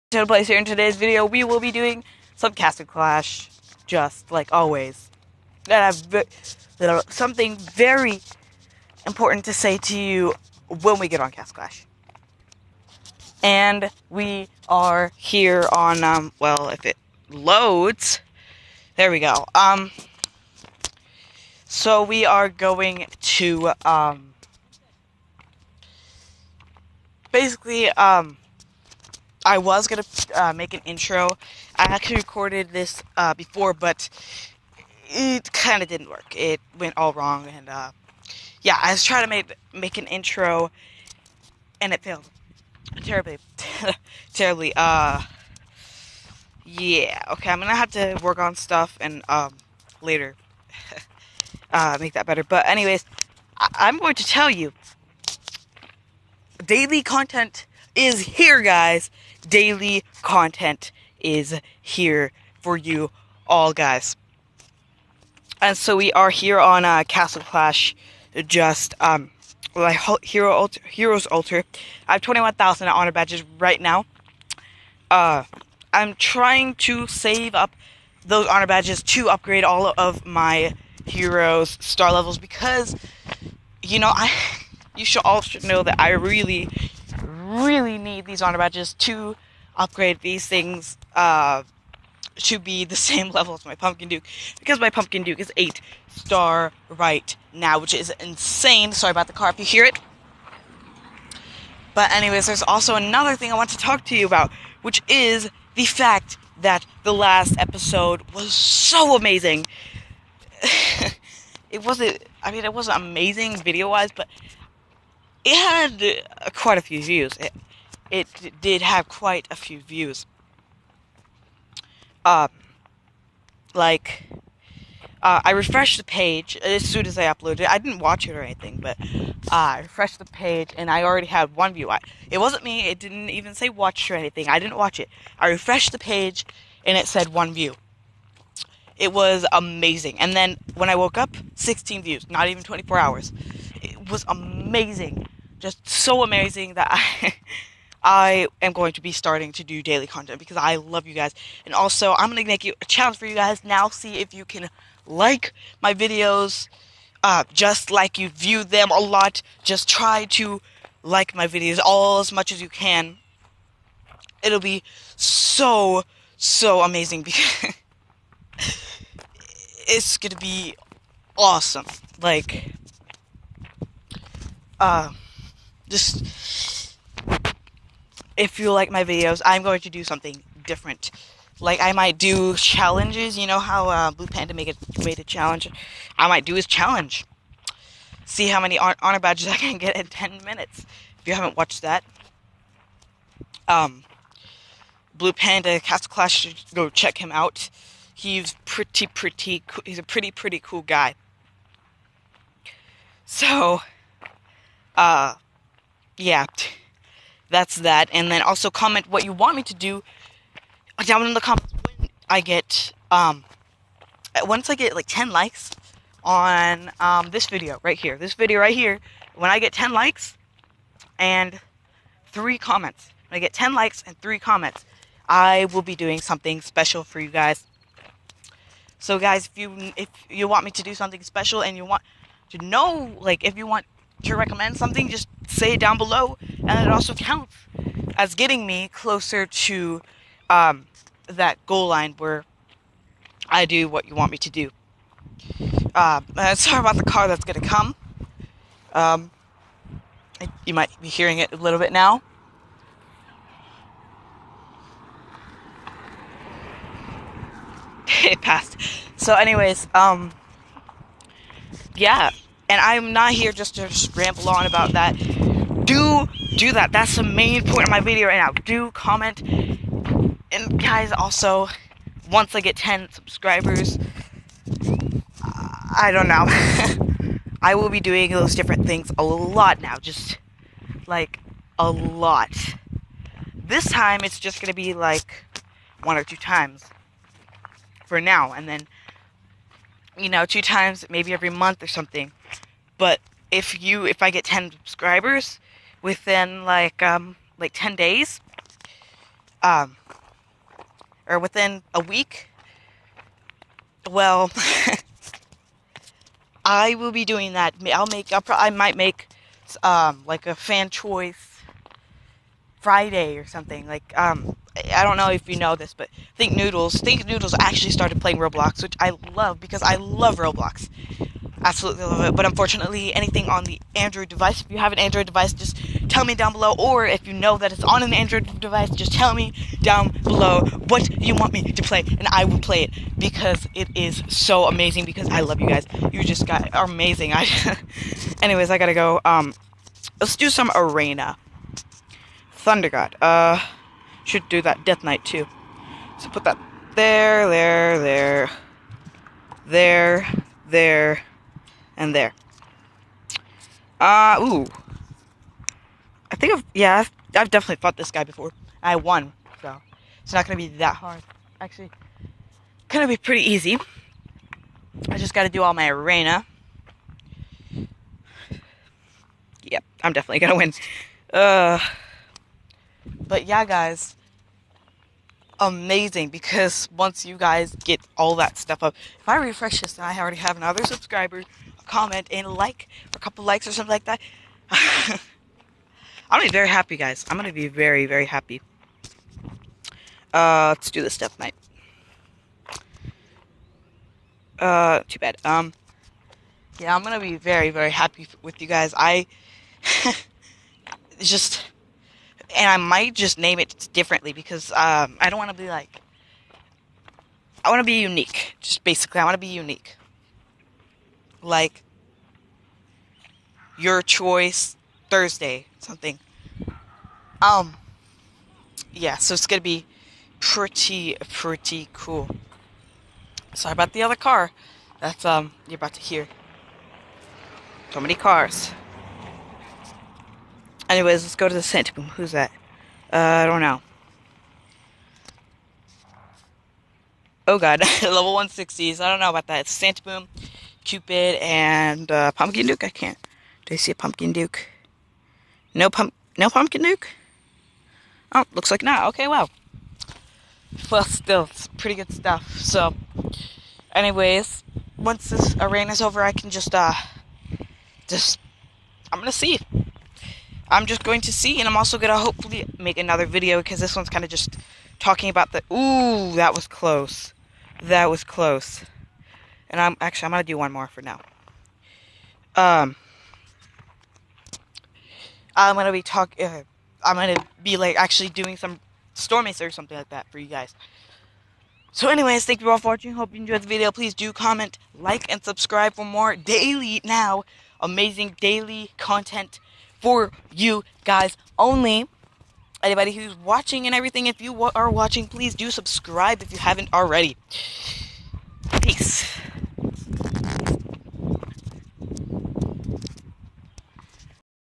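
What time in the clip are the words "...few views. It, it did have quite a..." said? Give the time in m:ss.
1:56.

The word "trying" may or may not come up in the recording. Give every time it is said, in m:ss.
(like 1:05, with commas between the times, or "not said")
0:39, 1:16.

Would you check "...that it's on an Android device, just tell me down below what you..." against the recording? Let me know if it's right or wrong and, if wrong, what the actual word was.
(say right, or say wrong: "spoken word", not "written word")
right.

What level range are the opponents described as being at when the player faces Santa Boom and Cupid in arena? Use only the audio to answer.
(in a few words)
160s.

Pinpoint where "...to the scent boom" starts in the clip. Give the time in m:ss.
7:11.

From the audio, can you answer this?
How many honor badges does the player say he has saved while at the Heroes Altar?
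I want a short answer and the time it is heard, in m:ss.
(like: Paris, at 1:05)
21,000, at 1:12.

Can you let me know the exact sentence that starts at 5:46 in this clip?
So put that there, there, there, there, there, and there.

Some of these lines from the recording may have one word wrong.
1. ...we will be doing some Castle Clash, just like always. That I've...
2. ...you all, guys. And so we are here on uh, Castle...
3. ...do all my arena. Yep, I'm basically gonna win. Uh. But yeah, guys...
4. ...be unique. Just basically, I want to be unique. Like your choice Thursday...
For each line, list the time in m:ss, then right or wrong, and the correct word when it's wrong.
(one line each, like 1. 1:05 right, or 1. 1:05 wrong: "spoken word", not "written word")
1. 0:01 right
2. 1:02 right
3. 6:05 wrong: "definitely", not "basically"
4. 6:47 right.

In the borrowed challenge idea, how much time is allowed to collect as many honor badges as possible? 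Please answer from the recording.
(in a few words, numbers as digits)
10 minutes.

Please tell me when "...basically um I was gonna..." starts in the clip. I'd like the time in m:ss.
0:27.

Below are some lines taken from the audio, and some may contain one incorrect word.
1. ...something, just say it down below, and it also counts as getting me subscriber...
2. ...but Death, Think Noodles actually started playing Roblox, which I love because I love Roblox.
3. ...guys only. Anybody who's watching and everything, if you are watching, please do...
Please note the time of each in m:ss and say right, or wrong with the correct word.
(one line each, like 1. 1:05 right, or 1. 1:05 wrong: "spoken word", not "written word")
1. 3:54 wrong: "closer", not "subscriber"
2. 5:15 wrong: "Thinknoodles", not "Death"
3. 8:11 right.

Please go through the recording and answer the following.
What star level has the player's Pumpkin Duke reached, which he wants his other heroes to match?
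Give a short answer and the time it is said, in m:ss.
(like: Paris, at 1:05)
8 star, at 1:35.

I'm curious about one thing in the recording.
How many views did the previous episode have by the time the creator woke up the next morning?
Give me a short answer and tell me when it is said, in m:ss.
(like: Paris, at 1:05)
16, at 2:21.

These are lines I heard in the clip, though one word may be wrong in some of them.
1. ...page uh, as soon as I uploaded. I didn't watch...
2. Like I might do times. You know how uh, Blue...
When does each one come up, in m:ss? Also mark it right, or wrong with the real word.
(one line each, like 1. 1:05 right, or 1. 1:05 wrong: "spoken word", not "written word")
1. 2:06 right
2. 3:01 wrong: "challenges", not "times".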